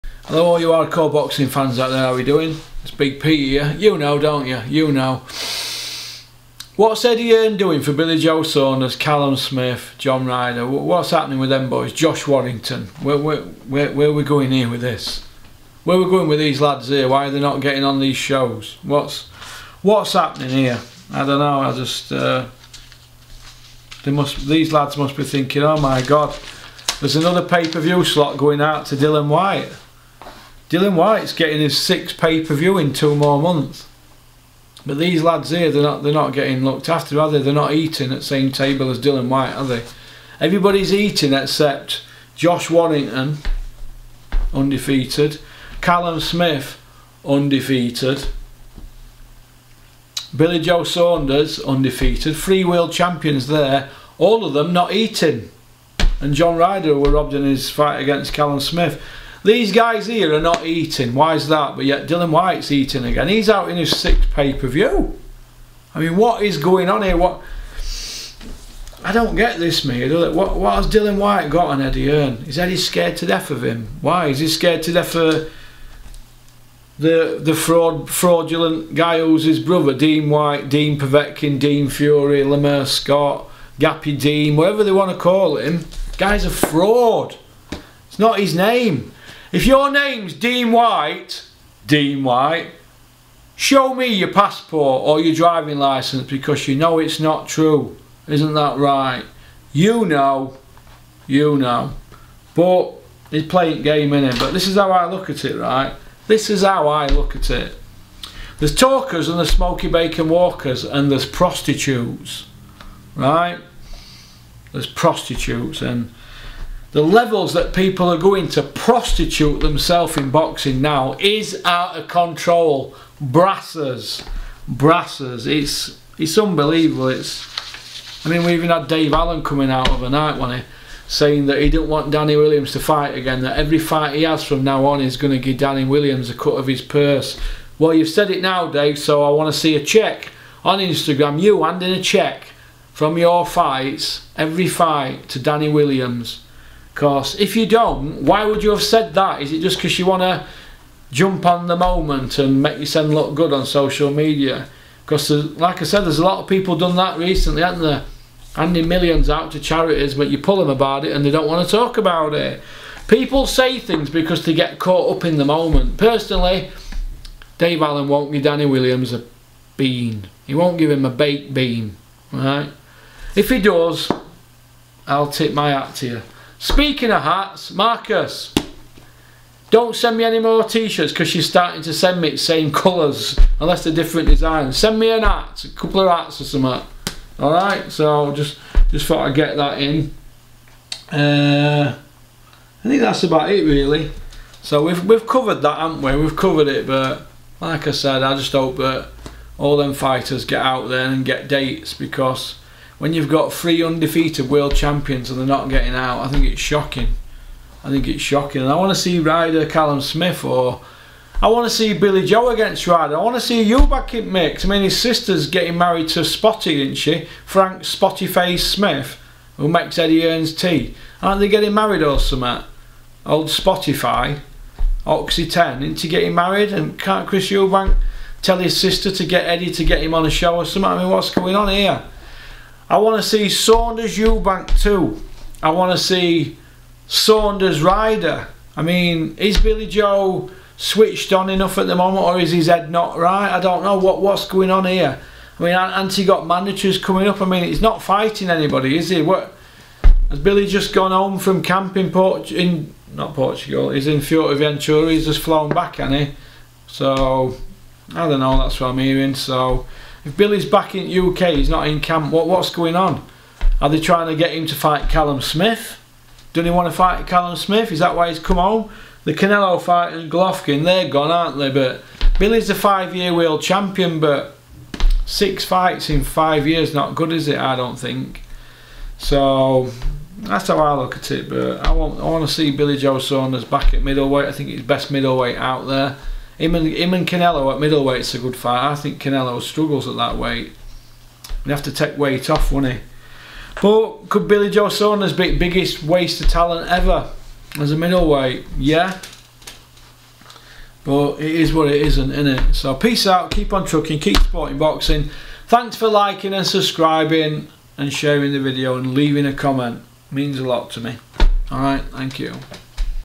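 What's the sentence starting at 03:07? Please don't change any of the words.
Alright, so just just thought I'd get that in.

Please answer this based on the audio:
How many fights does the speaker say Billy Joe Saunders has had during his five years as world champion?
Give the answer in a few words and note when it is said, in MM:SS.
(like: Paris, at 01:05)
6, at 04:35.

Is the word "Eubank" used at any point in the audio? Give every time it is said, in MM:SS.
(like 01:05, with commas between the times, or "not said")
03:47, 03:54.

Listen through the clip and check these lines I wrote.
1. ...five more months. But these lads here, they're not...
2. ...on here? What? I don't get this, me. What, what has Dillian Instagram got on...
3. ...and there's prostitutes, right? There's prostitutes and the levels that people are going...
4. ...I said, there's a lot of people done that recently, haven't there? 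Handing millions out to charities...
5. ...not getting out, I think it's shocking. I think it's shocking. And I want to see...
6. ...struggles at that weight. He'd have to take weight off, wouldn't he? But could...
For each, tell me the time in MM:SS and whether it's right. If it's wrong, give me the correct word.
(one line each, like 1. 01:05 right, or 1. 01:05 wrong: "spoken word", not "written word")
1. 00:32 wrong: "two", not "five"
2. 01:06 wrong: "Whyte", not "Instagram"
3. 01:50 right
4. 02:35 right
5. 03:25 right
6. 04:49 right.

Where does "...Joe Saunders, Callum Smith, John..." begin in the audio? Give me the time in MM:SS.
00:08.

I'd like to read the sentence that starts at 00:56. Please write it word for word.
And John Ryder were robbed in his fight against Callum Smith.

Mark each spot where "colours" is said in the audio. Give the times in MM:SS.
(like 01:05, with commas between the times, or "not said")
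03:02.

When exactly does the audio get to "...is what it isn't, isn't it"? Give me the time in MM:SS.
05:01.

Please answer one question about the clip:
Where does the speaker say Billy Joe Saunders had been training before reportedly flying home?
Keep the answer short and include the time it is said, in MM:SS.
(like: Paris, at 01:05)
Fuerteventura, at 04:14.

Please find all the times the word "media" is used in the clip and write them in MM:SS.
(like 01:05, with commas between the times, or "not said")
02:34.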